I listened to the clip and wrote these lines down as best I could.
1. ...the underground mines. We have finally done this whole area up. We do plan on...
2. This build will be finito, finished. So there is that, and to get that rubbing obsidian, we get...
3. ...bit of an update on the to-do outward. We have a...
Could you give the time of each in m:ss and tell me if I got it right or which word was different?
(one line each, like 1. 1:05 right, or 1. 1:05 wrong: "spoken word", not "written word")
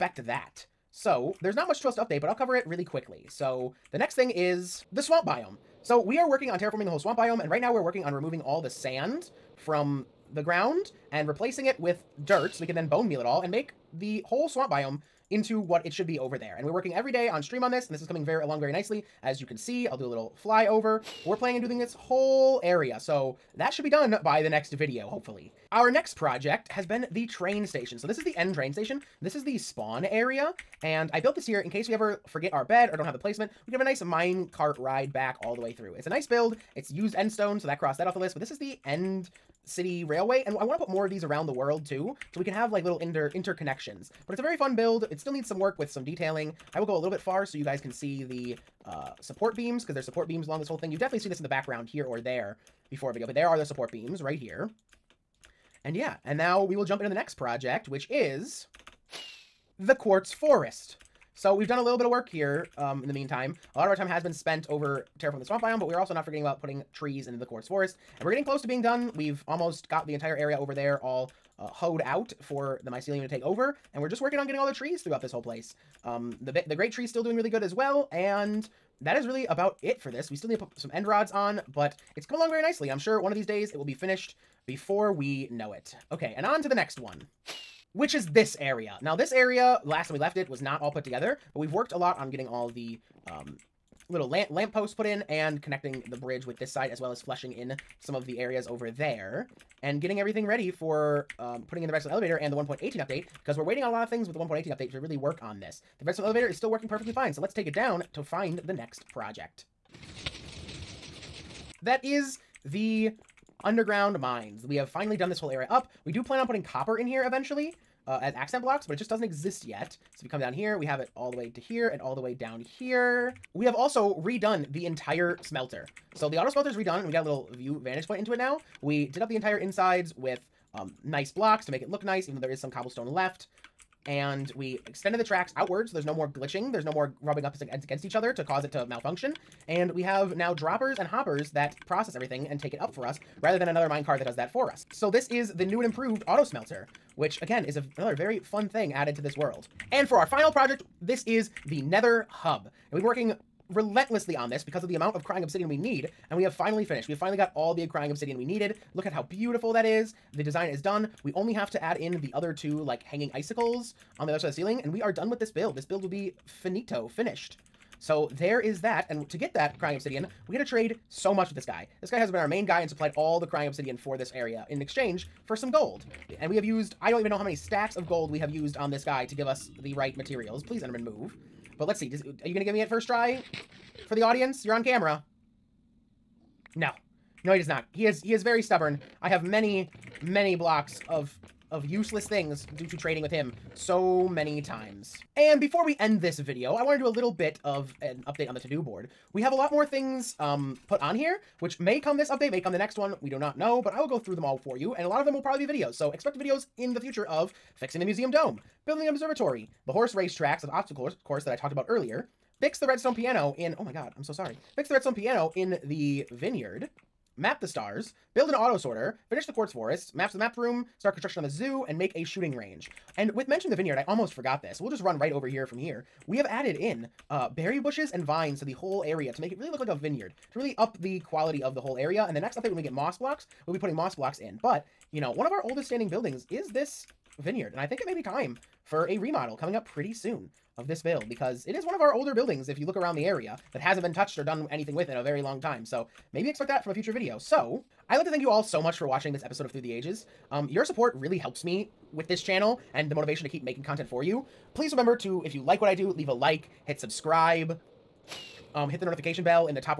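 1. 1:52 right
2. 2:45 wrong: "crying", not "rubbing"
3. 3:17 wrong: "board", not "outward".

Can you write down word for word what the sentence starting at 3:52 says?
And the next update, when we get moss blocks, we'll be putting moss blocks in.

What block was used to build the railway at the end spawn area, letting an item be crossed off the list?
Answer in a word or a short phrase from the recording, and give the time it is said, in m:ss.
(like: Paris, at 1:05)
End stone, at 0:37.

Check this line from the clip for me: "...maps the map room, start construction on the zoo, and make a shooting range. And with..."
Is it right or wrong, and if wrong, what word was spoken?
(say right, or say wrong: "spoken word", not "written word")
right.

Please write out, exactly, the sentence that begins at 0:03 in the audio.
So the next thing is the swamp biome.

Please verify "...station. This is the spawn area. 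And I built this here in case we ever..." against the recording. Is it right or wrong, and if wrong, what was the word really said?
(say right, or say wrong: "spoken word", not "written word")
right.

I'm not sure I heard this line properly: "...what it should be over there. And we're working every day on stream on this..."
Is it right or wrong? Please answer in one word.
right.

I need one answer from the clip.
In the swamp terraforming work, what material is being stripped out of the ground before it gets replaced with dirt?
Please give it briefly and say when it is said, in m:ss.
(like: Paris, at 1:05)
Sand, at 0:08.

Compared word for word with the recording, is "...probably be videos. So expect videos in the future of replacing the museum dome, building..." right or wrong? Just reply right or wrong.
wrong.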